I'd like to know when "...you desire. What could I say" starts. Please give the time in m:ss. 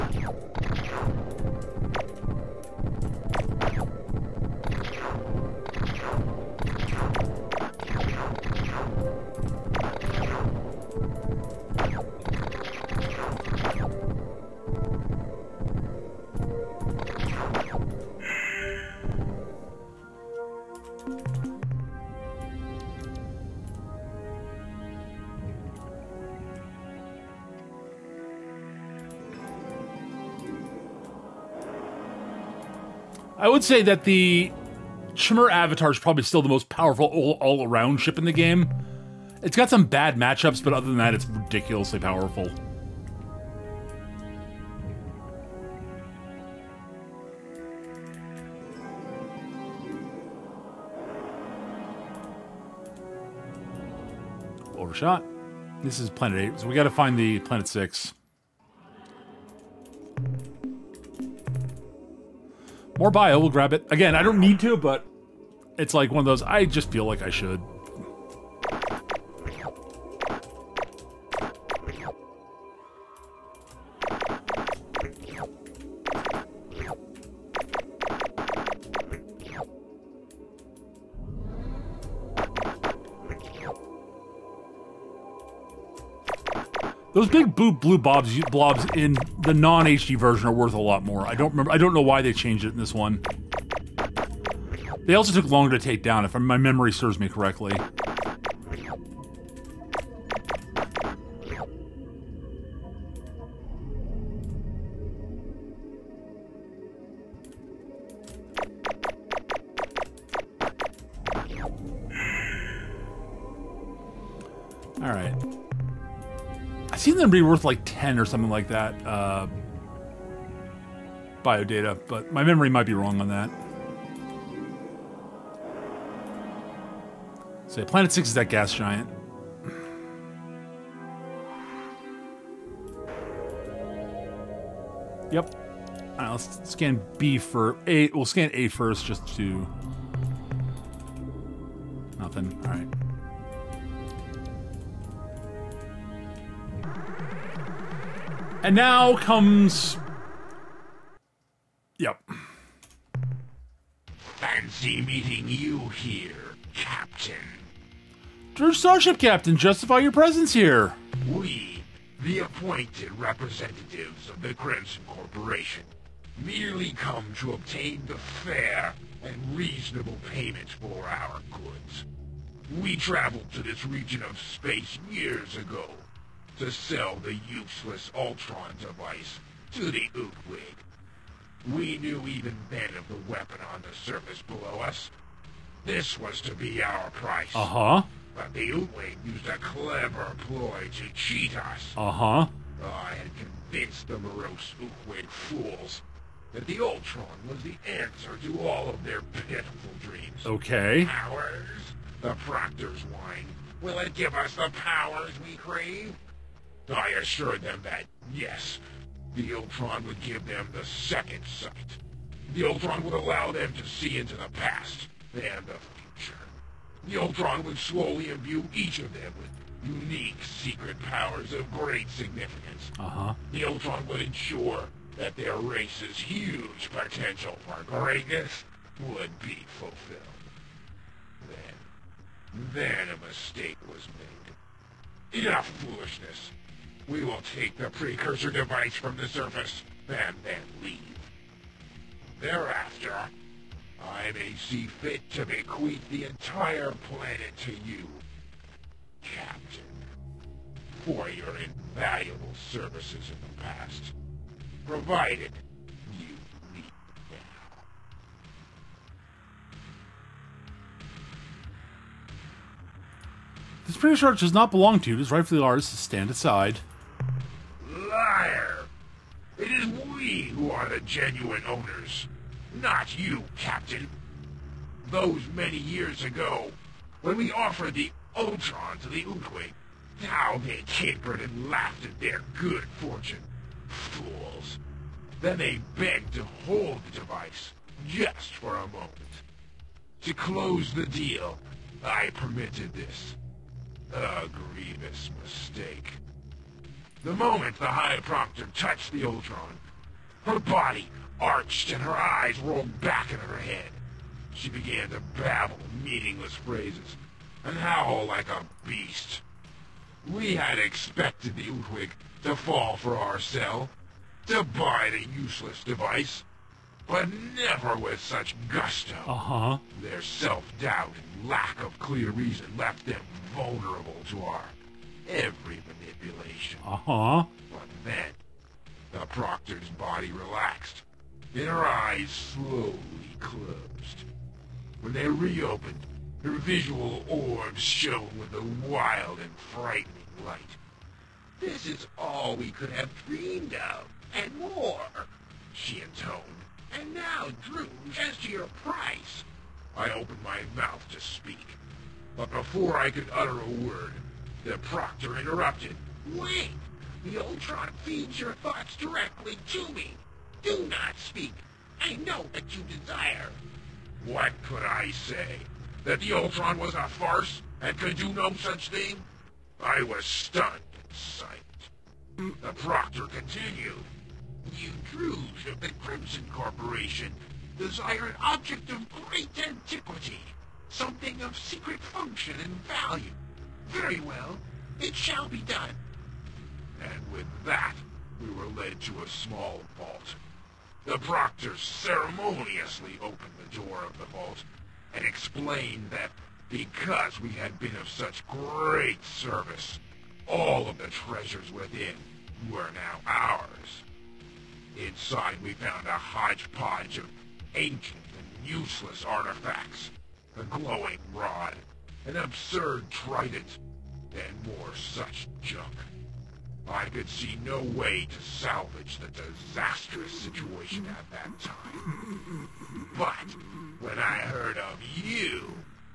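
6:02.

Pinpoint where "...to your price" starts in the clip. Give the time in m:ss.
5:48.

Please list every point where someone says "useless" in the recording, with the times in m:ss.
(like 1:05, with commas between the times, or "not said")
2:57, 5:15, 6:48.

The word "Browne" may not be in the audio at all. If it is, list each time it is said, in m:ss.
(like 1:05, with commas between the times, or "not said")
not said.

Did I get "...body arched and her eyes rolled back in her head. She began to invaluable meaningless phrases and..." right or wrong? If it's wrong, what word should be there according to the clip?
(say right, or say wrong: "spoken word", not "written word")
wrong: "babble", not "invaluable".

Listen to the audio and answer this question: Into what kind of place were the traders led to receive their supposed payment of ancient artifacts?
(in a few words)
a small vault.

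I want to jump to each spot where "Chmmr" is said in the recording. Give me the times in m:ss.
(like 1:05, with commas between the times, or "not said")
0:35.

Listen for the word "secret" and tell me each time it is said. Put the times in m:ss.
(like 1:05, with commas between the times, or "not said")
3:40, 6:21.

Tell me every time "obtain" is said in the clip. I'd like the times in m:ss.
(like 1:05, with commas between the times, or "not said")
2:47.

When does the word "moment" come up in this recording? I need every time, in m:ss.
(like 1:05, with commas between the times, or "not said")
4:48, 4:57.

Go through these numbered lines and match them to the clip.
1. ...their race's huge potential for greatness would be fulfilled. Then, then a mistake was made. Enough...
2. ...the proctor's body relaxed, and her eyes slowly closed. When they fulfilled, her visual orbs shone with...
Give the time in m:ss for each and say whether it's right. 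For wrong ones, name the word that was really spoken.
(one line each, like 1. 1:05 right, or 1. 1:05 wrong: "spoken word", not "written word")
1. 3:45 right
2. 5:29 wrong: "reopened", not "fulfilled".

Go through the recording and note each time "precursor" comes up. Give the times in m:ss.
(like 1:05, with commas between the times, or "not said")
3:57, 4:23.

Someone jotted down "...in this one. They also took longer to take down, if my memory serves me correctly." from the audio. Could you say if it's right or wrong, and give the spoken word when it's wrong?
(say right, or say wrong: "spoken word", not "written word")
right.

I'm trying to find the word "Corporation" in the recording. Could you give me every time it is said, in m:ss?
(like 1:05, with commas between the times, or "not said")
2:45, 6:16.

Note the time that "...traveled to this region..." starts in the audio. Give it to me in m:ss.
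2:52.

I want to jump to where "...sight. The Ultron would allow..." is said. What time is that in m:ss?
3:31.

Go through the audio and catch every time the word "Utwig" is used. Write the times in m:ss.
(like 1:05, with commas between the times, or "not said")
3:00, 3:08, 3:14, 4:39, 5:11.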